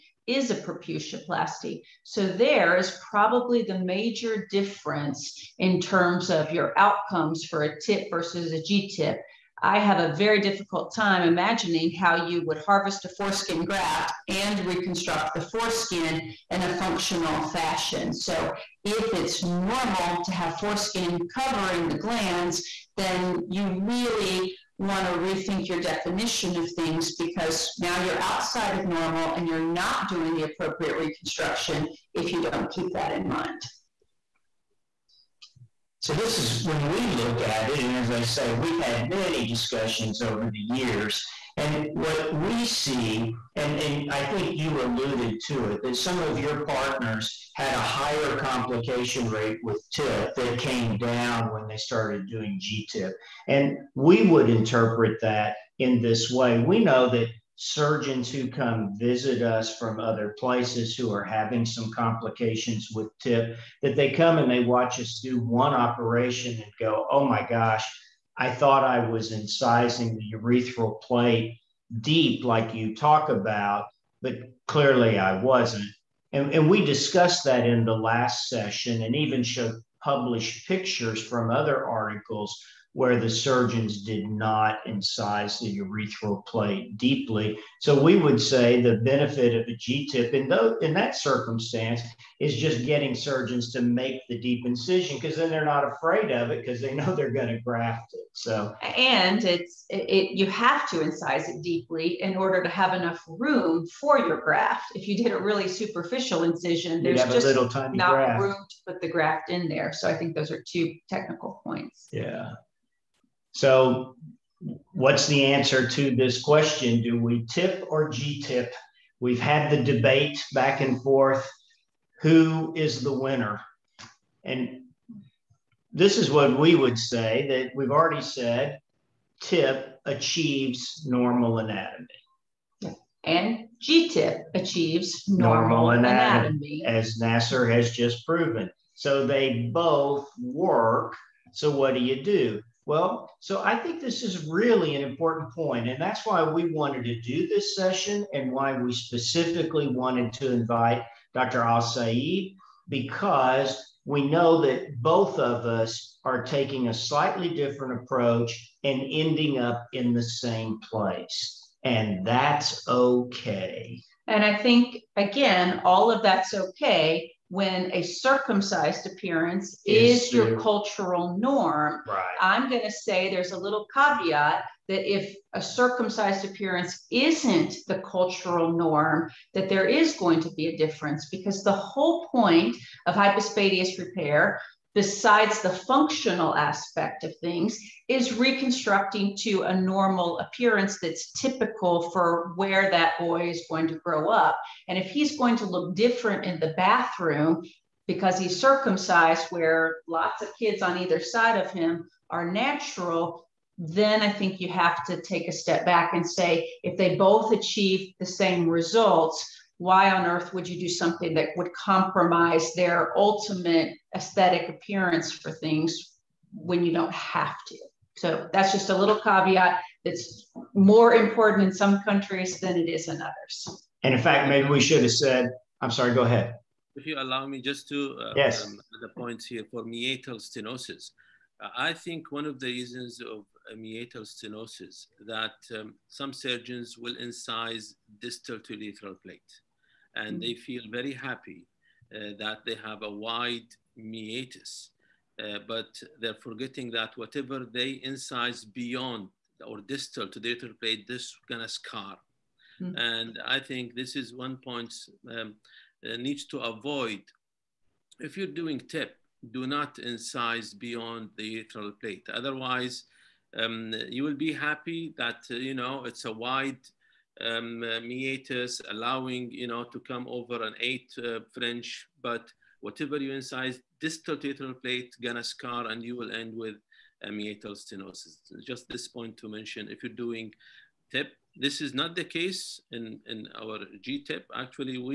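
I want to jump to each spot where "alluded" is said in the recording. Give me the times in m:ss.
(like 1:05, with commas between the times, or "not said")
0:44.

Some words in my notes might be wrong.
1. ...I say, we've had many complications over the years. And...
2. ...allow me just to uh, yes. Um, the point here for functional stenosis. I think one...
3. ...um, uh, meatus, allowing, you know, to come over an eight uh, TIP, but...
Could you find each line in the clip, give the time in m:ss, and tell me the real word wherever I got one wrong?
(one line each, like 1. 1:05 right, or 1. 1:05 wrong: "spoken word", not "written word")
1. 0:38 wrong: "discussions", not "complications"
2. 3:47 wrong: "meatal", not "functional"
3. 4:27 wrong: "French", not "TIP".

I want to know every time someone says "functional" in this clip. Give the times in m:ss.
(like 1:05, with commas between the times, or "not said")
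0:16, 3:05.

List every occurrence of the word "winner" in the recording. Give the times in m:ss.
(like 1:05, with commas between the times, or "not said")
2:03.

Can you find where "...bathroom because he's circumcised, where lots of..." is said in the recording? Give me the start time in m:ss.
3:16.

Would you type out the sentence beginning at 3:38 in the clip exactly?
So that's just a little caveat that's more important in some countries than it is in others.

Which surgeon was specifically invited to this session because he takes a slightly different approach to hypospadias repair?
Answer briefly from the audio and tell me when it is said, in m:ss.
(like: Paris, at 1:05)
Dr. Alsaid, at 2:31.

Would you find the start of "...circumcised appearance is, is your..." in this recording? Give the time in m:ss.
2:48.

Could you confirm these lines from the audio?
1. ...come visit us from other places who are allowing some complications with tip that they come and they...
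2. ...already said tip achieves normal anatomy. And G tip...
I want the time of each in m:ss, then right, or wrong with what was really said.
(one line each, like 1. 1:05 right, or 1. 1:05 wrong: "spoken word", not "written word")
1. 0:58 wrong: "having", not "allowing"
2. 2:07 right.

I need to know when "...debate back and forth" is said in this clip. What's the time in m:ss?
1:59.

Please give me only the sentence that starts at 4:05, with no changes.
Uh, but they're forgetting that whatever they incise beyond or distal to the urethral plate, this gonna scar.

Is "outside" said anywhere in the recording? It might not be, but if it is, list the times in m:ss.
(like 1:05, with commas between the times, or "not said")
0:28.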